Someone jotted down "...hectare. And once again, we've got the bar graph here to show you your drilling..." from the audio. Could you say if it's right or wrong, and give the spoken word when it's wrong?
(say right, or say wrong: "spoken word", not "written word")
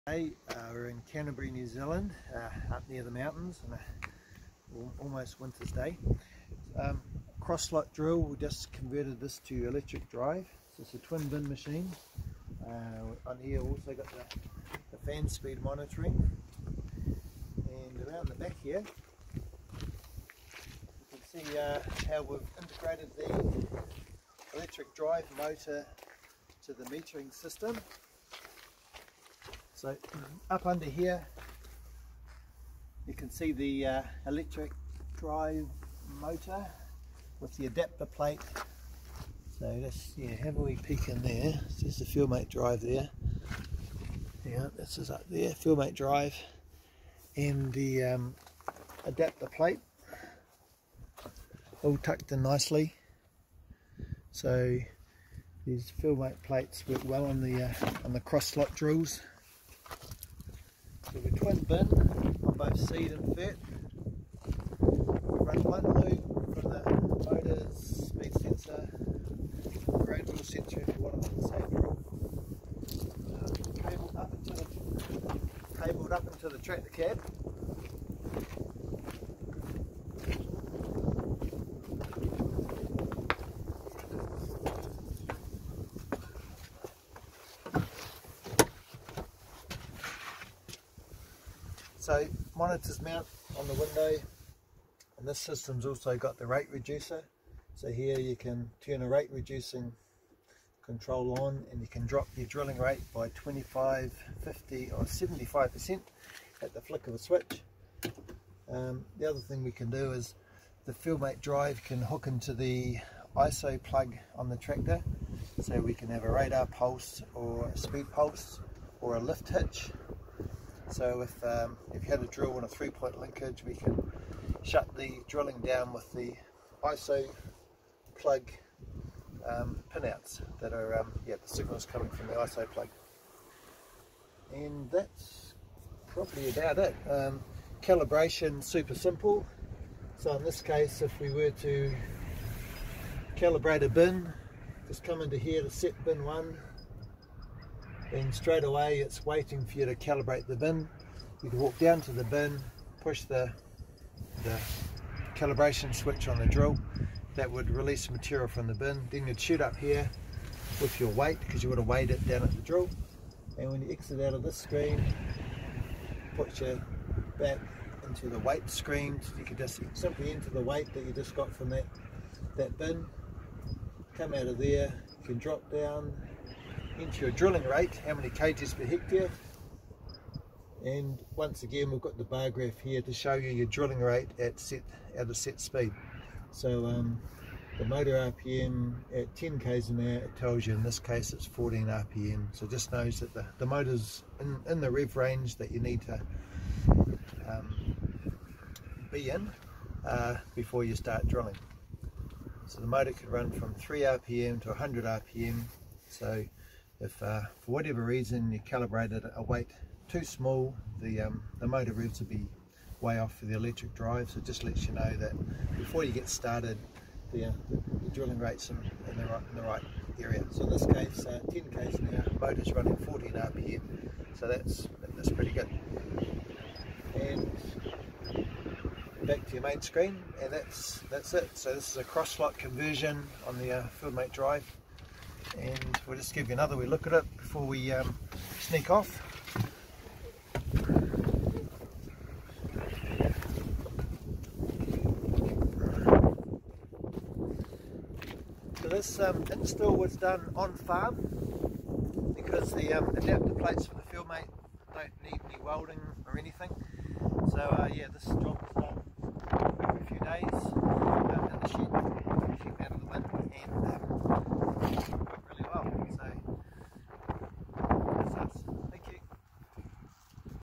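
right.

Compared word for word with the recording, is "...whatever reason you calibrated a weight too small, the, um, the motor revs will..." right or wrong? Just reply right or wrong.
right.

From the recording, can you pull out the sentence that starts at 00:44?
Yeah, this is up there, FieldMate drive and the um, adapter plate all tucked in nicely.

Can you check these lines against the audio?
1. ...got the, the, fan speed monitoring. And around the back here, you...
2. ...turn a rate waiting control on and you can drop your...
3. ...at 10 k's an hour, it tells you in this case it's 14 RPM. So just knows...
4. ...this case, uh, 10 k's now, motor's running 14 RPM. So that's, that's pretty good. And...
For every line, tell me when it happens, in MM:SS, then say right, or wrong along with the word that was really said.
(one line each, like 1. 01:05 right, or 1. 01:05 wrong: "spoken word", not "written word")
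1. 00:13 right
2. 01:38 wrong: "reducing", not "waiting"
3. 03:09 right
4. 03:40 right.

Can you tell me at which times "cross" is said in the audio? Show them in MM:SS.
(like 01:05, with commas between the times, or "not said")
00:07, 00:58, 03:52.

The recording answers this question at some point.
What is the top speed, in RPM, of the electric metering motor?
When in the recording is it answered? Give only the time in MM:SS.
03:24.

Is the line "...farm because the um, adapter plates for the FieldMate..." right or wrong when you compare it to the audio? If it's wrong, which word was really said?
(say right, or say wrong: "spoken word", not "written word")
right.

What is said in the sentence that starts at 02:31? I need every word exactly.
You can walk down to the bin, push the, the calibration switch on the drill, that would release material from the bin.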